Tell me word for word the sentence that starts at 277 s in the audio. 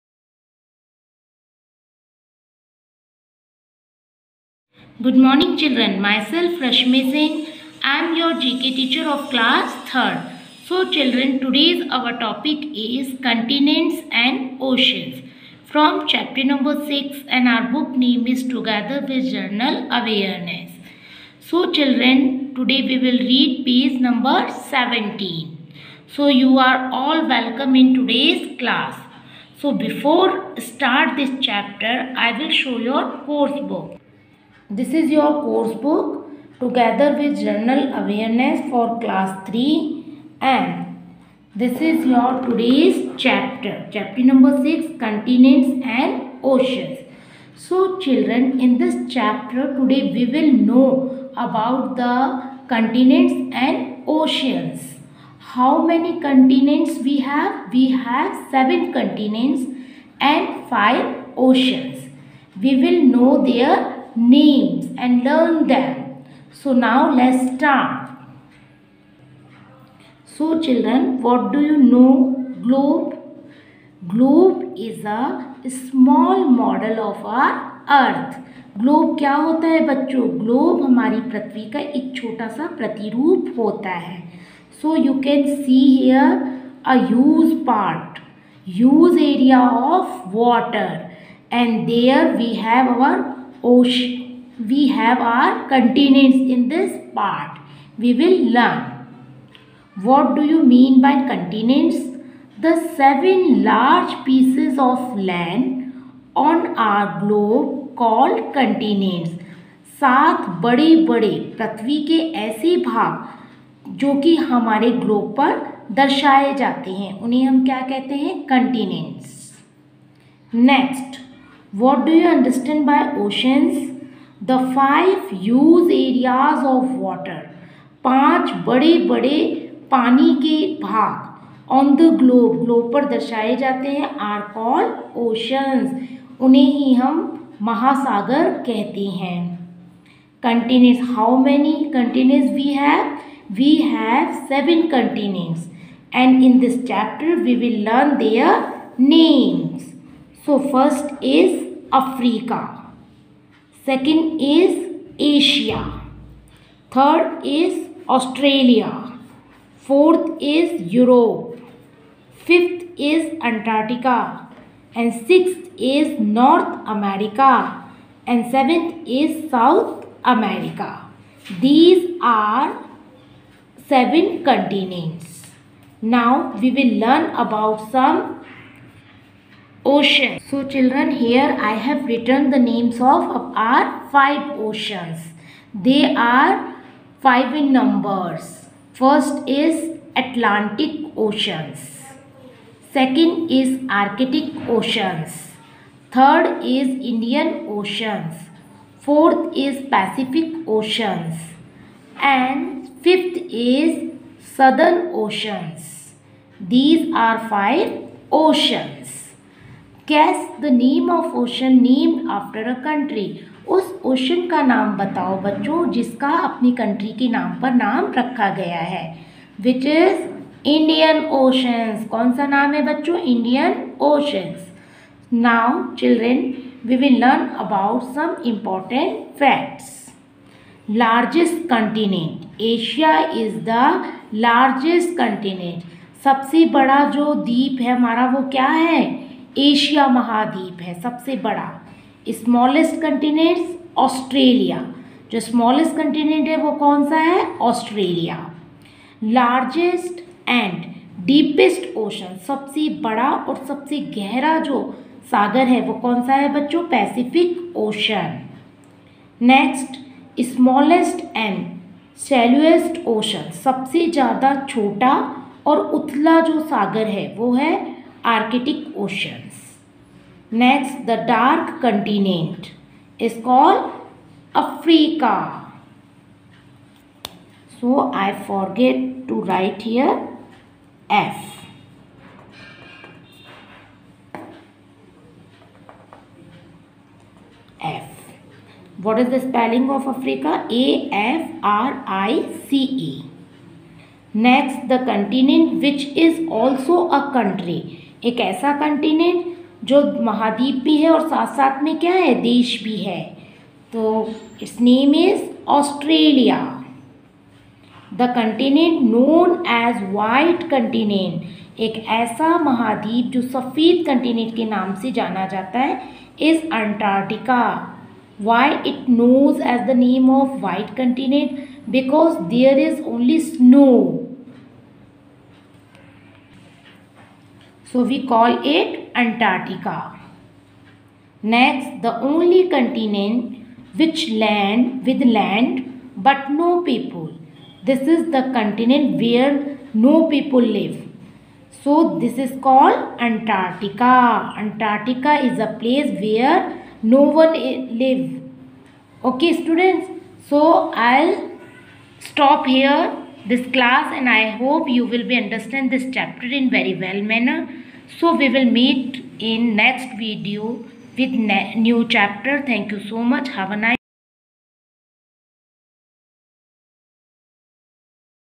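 So, I forget to write here F.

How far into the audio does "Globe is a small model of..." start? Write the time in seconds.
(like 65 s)
74 s.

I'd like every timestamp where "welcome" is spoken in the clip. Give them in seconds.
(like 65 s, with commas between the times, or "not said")
27 s.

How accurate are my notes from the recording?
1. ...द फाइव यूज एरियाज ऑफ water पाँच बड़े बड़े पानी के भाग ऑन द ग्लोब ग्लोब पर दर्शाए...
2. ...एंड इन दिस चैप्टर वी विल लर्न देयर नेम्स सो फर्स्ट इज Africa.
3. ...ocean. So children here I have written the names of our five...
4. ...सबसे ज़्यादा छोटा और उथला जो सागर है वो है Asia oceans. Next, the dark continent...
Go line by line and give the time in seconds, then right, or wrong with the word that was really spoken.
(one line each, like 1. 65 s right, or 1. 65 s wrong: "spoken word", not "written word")
1. 124 s right
2. 146 s right
3. 179 s right
4. 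263 s wrong: "Arctic", not "Asia".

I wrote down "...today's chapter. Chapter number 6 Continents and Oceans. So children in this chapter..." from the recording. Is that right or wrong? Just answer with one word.
right.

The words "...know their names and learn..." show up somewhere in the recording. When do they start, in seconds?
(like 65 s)
63 s.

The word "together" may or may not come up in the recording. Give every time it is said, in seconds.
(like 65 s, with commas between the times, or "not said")
18 s, 36 s.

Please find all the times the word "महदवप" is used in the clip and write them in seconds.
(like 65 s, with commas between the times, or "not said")
240 s, 300 s, 312 s.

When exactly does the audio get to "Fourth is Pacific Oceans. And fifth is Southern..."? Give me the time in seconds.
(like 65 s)
198 s.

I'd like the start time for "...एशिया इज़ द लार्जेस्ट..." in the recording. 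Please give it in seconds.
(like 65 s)
232 s.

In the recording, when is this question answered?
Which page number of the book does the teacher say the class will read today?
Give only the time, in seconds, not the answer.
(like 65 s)
24 s.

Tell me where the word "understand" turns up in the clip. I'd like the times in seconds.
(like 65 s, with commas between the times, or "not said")
122 s, 355 s.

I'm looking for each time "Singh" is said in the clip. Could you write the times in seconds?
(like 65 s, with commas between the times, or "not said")
7 s.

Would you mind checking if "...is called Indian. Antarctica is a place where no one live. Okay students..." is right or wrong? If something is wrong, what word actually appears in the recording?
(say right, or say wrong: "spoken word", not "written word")
wrong: "Antarctica", not "Indian".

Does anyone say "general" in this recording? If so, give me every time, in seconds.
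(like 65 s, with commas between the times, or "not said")
19 s, 37 s.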